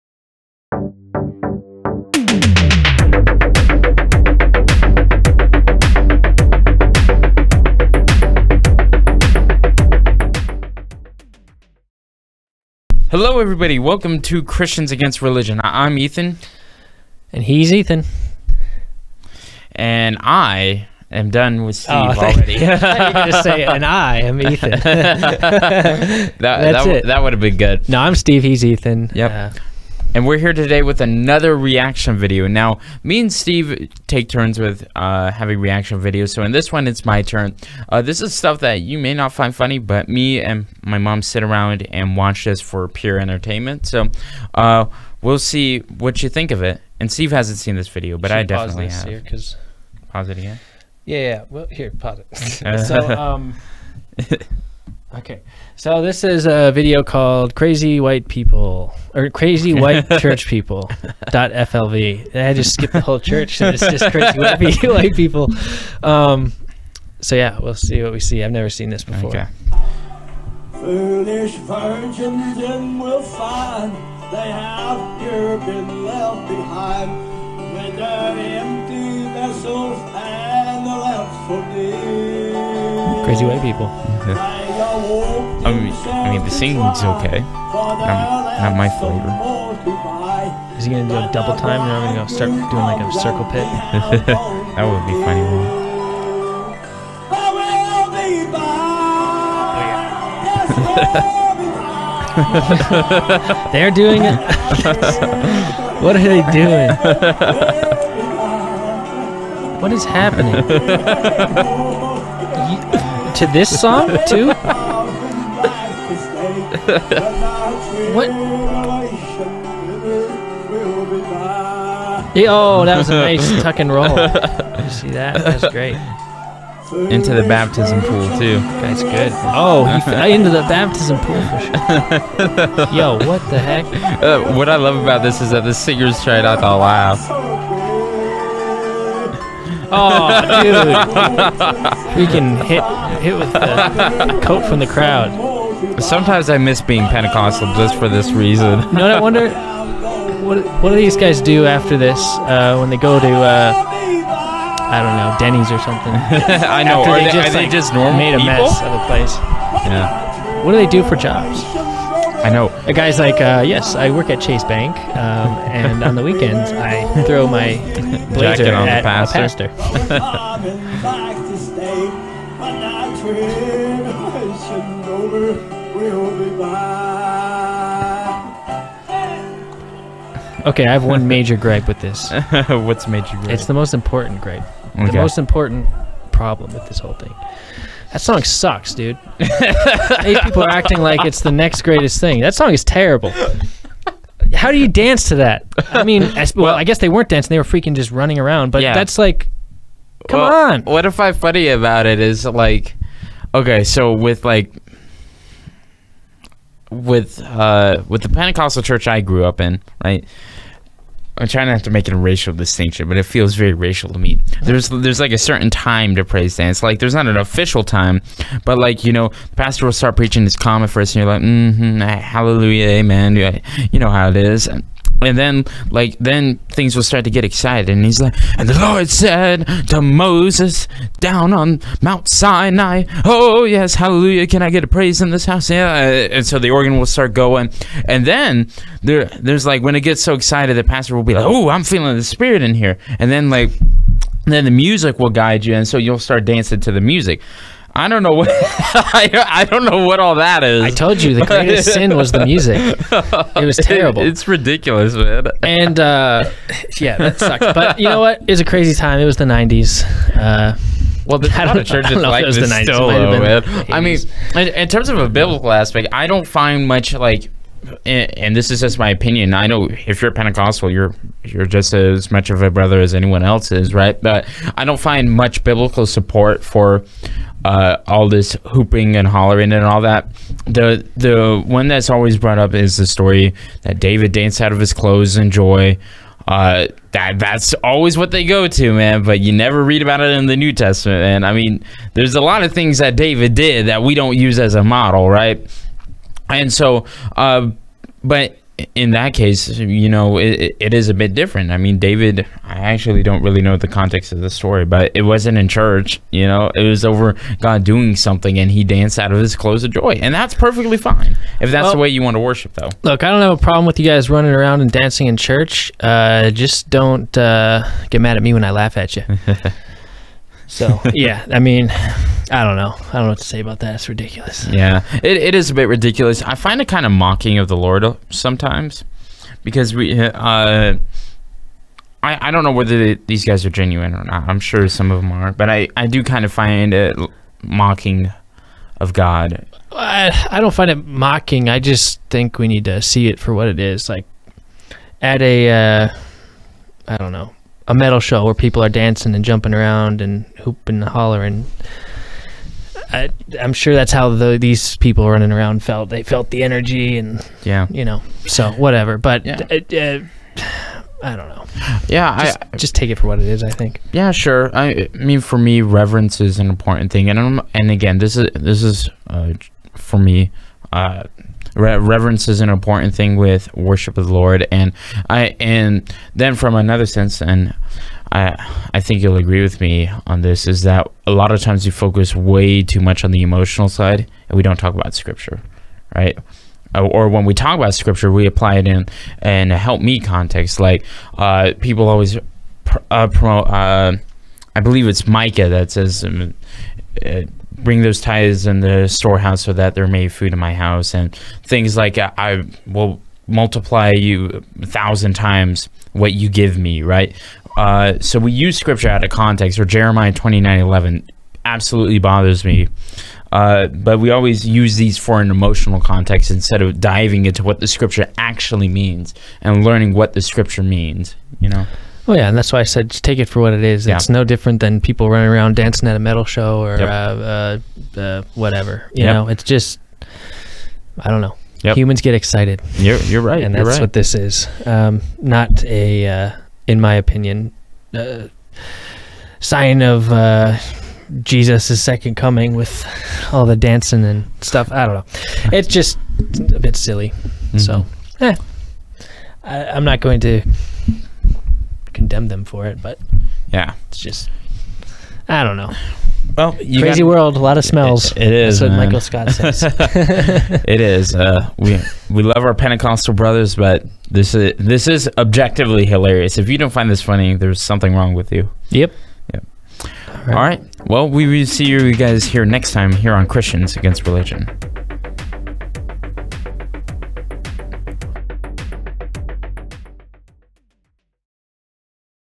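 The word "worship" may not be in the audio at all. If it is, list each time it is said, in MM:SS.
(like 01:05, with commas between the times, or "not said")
05:12, 06:13.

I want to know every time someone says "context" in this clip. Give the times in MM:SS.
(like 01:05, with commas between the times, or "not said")
05:03, 06:30, 06:49, 06:55.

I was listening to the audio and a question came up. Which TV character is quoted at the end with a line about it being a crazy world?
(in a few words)
Michael Scott.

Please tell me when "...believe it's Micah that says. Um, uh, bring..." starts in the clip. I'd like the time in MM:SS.
06:34.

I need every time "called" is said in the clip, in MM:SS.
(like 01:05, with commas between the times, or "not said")
00:57.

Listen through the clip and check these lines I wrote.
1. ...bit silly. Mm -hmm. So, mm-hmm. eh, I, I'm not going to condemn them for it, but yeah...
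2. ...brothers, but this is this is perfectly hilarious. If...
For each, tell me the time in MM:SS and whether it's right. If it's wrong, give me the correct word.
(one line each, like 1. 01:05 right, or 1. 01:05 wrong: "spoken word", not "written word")
1. 07:26 right
2. 07:43 wrong: "objectively", not "perfectly".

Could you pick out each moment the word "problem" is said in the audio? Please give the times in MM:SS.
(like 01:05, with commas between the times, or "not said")
03:06, 05:13.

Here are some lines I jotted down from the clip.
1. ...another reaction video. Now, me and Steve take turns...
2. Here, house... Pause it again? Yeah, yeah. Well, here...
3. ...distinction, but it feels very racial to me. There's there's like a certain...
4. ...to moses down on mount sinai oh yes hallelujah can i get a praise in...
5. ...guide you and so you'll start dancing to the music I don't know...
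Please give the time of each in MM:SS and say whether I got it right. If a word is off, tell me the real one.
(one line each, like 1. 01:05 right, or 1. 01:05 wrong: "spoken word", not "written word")
1. 00:30 right
2. 00:49 wrong: "cause", not "house"
3. 03:32 right
4. 03:49 right
5. 04:05 right.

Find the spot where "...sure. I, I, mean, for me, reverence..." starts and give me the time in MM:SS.
06:04.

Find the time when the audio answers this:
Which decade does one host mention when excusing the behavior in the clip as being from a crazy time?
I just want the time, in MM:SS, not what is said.
04:19.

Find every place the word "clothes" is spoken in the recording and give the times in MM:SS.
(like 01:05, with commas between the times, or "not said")
04:44, 05:09.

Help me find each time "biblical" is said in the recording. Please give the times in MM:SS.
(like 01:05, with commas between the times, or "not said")
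04:25, 04:35.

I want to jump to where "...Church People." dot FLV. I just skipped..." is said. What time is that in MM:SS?
01:00.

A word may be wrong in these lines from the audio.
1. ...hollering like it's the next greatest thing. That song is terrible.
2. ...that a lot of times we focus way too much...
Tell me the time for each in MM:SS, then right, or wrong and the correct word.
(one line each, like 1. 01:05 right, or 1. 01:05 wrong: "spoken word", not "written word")
1. 03:10 wrong: "acting", not "hollering"
2. 06:20 right.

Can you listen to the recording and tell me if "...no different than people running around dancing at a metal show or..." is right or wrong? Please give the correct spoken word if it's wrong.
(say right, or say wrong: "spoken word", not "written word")
right.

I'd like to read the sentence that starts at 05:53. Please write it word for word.
I, am sure that's how the, these people running around felt.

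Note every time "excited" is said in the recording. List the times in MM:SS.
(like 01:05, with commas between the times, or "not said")
03:47, 04:00, 07:12.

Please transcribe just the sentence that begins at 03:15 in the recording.
I mean, well, I guess they weren't dancing; they were freaking just running around.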